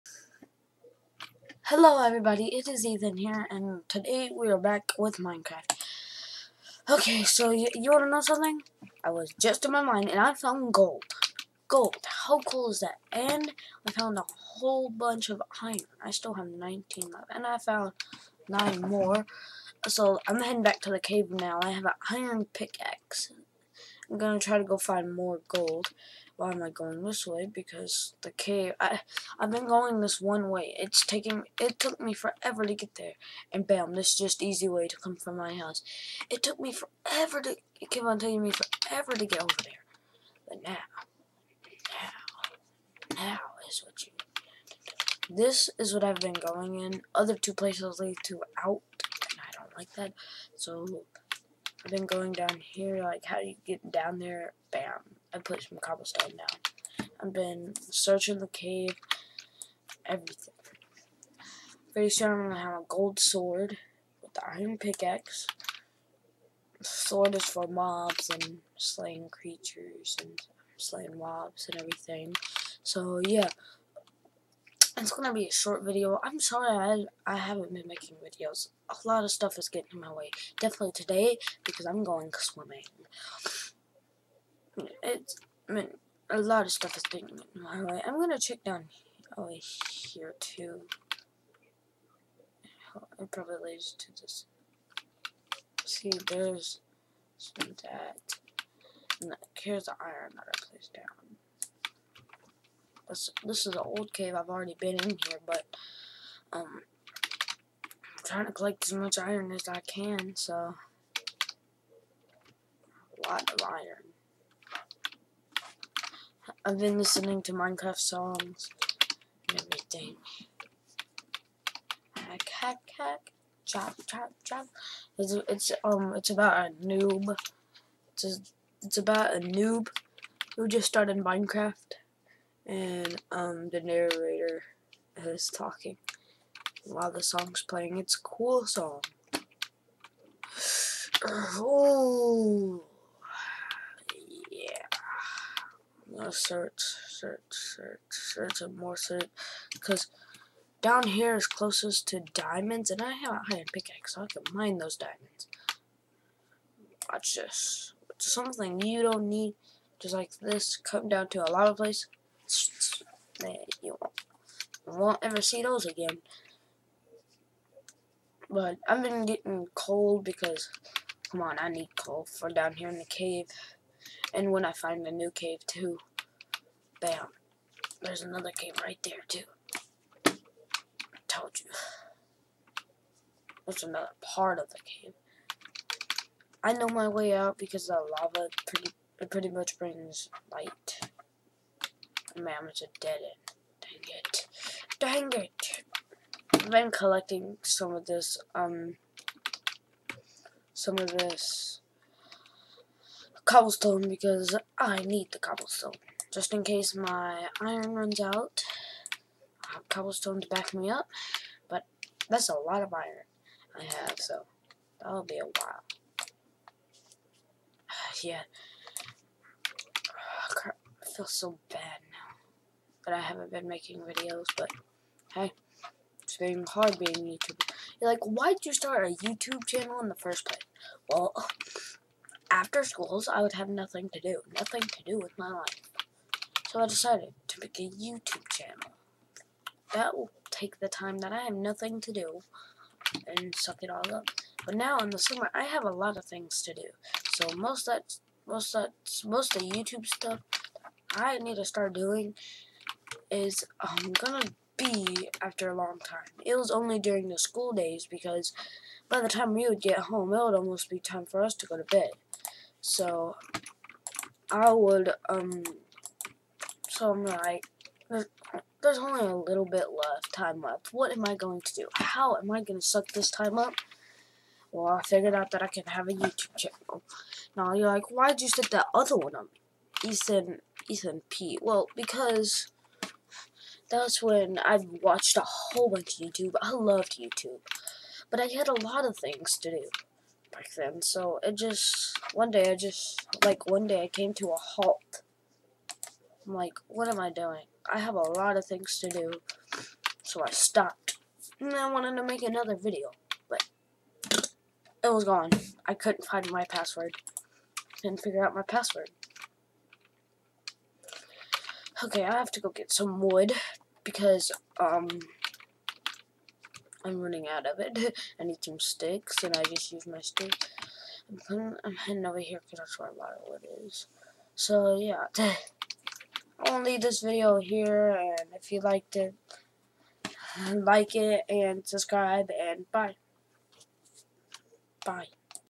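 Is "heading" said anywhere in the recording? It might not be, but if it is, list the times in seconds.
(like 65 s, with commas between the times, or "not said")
20 s, 321 s.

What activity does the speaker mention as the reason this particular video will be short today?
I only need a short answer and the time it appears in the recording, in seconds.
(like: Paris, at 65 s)
swimming, at 81 s.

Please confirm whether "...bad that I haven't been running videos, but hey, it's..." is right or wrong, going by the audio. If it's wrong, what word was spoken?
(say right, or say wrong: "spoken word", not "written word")
wrong: "making", not "running".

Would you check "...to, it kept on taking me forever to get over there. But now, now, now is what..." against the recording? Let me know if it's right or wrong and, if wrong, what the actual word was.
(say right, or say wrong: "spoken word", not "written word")
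right.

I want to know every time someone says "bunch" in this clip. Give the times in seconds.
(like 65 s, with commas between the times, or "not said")
14 s, 285 s.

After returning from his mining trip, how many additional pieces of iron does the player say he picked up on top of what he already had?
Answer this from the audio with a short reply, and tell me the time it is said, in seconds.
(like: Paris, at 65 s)
9, at 18 s.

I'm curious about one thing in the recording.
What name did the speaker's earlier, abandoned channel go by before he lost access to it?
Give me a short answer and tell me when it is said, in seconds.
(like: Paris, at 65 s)
Ethan P, at 280 s.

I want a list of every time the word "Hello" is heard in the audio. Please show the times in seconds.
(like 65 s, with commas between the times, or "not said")
1 s.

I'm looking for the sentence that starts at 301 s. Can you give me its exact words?
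And I wanted to make another video, but it was gone.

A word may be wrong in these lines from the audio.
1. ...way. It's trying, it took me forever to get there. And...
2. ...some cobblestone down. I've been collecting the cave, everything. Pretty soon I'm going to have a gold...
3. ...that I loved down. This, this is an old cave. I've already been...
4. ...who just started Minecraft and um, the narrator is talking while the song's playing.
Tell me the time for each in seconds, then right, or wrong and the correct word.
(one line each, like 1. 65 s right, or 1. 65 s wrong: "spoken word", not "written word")
1. 30 s wrong: "taking", not "trying"
2. 55 s wrong: "searching", not "collecting"
3. 100 s wrong: "placed", not "loved"
4. 130 s right.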